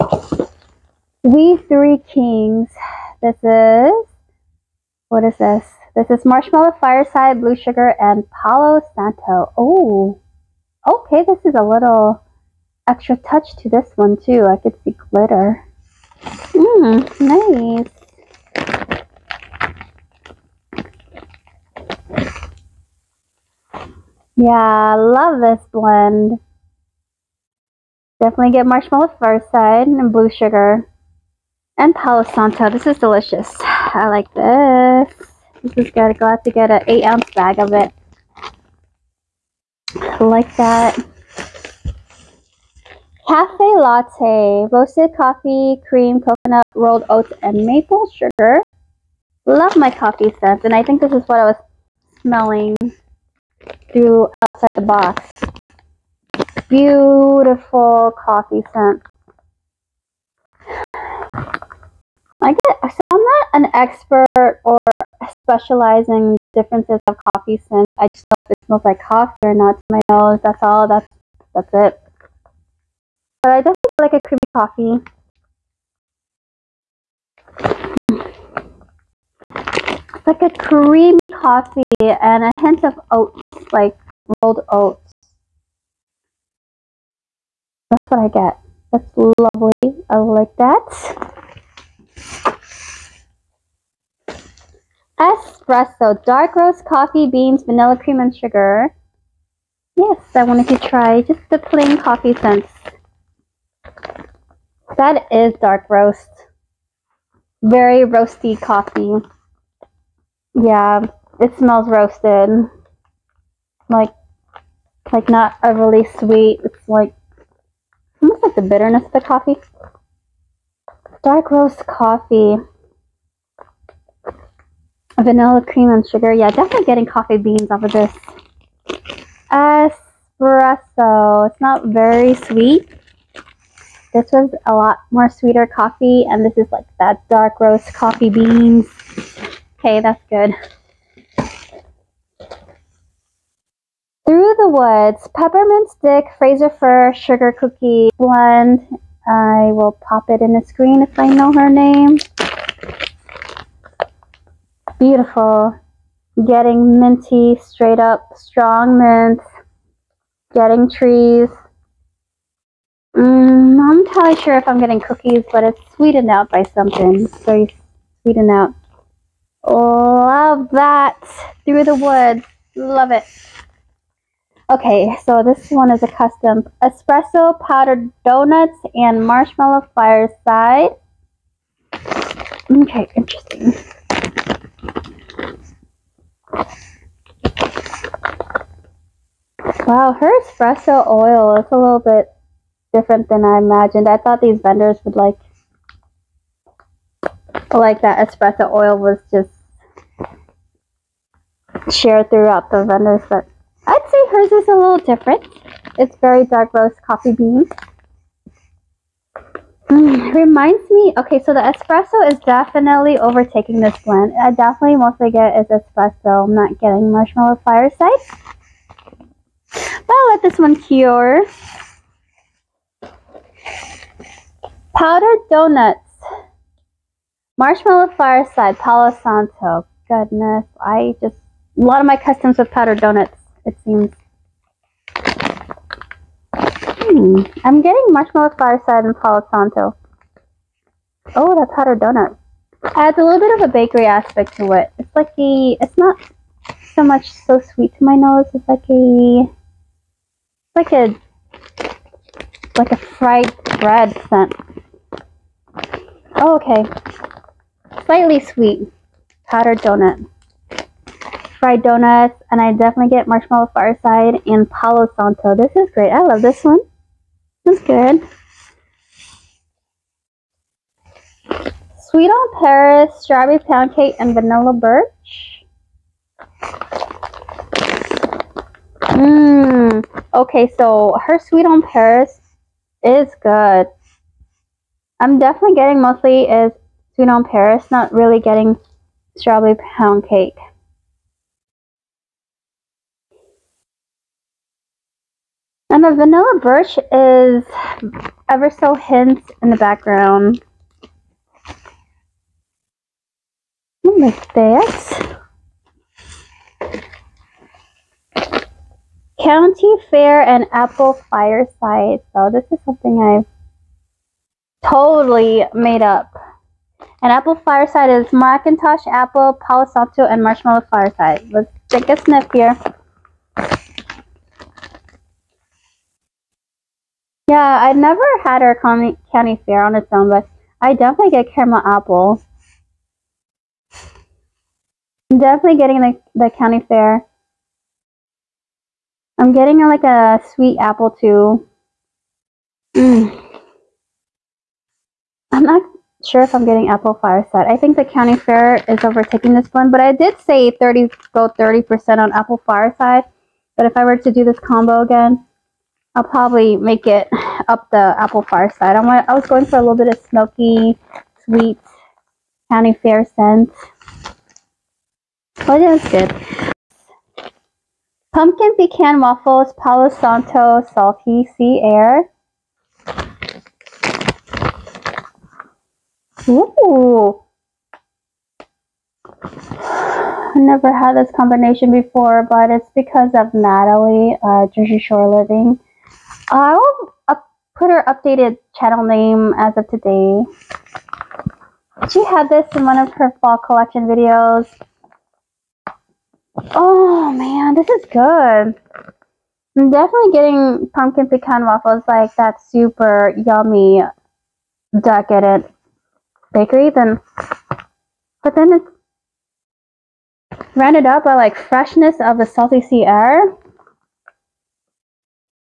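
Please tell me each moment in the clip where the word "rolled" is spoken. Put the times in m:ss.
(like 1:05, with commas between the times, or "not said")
0:46, 1:24.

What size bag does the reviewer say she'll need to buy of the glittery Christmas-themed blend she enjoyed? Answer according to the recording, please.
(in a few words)
8 ounce.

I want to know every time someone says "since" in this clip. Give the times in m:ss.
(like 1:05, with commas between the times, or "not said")
1:07, 1:42.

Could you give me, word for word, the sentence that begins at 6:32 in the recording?
She had this in one of her fall collection videos.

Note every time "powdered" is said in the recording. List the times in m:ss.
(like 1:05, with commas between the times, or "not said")
2:57, 3:44, 3:52, 4:19.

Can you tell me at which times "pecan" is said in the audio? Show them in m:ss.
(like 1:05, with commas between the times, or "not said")
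6:08, 6:41.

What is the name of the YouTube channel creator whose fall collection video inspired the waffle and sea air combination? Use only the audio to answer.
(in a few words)
Jersey Shore Living.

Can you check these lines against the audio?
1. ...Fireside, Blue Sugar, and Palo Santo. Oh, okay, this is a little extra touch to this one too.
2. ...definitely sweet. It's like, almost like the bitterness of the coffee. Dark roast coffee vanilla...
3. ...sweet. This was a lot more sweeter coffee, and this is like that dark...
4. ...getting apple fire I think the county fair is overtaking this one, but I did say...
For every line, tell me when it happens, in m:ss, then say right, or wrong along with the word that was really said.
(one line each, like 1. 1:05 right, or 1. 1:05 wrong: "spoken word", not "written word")
1. 0:06 right
2. 1:55 wrong: "overly", not "definitely"
3. 2:12 right
4. 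5:46 right.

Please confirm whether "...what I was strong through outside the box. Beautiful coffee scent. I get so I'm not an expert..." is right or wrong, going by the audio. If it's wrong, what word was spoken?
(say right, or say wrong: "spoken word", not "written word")
wrong: "smelling", not "strong".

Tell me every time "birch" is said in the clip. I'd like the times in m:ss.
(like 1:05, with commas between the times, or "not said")
4:34, 4:56.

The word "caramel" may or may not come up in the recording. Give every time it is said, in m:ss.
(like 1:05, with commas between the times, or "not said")
5:31.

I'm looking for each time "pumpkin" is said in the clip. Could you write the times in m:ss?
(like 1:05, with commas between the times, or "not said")
6:08, 6:40.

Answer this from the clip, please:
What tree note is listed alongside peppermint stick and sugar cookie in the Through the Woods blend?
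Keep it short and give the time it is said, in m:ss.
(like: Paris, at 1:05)
Fraser Fir, at 2:26.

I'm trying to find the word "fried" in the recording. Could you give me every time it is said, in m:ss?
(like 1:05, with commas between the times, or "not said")
4:12, 4:21.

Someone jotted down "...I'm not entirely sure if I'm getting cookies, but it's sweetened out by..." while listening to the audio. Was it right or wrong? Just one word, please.
right.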